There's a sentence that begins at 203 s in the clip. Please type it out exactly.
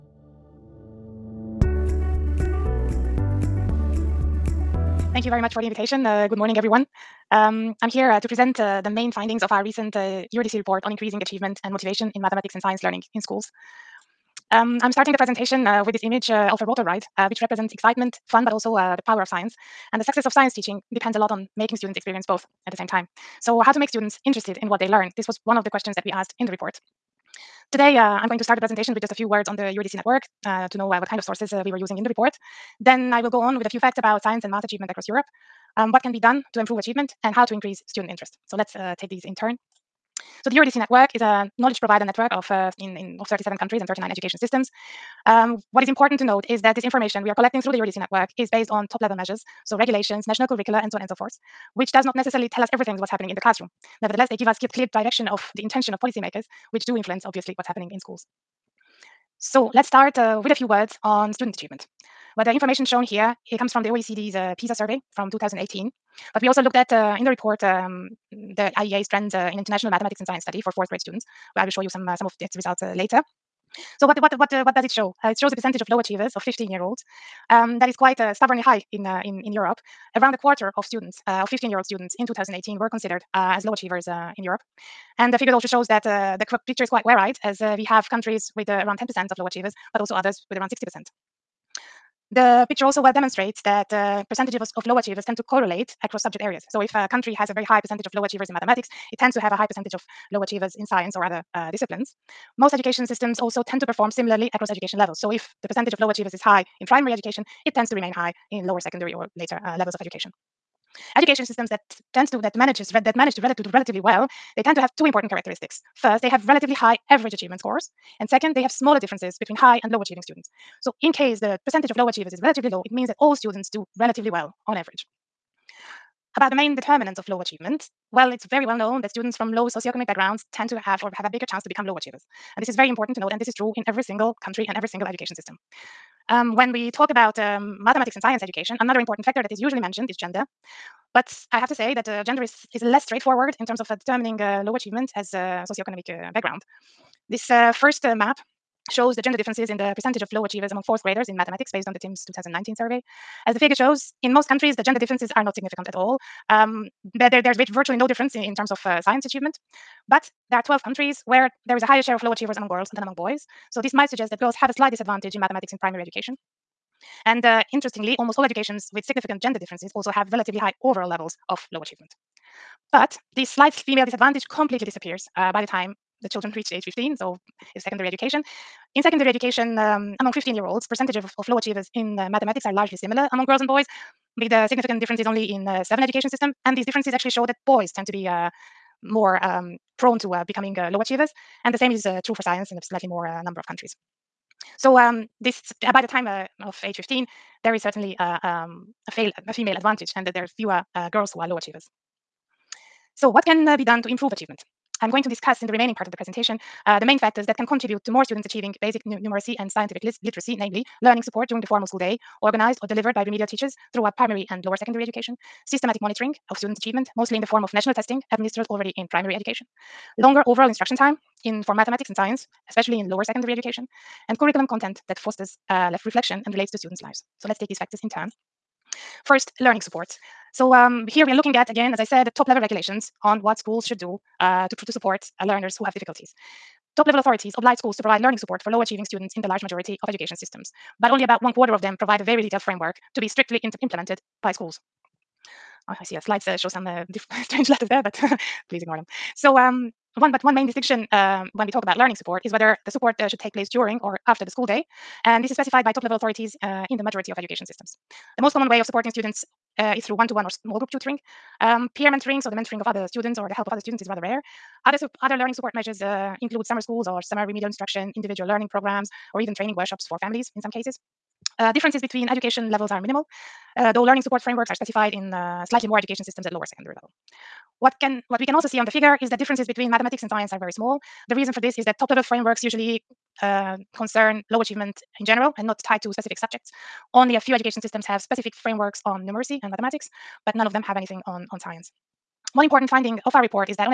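So what can uh, be done to improve achievement?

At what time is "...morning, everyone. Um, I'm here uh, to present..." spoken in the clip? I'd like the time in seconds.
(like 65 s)
6 s.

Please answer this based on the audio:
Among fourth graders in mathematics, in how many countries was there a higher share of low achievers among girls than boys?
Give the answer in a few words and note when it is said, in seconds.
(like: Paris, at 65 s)
12, at 160 s.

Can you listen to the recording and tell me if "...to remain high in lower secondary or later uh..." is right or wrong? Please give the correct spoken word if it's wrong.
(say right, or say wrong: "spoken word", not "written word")
right.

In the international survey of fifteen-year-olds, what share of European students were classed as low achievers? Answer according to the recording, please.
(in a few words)
around a quarter.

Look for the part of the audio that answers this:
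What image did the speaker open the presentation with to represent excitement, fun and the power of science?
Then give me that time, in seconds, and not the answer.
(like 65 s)
16 s.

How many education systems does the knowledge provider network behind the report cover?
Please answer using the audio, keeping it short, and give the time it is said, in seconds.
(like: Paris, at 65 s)
39, at 43 s.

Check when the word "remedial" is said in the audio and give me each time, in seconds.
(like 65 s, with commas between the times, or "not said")
213 s, 267 s.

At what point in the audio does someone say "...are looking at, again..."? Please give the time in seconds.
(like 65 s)
231 s.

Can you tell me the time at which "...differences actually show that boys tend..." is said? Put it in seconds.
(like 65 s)
186 s.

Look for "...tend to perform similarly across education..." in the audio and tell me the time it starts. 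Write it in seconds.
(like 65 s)
103 s.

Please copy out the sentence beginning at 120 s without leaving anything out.
So in case the percentage of low achievers is relatively low, it means that all students do relatively well on average.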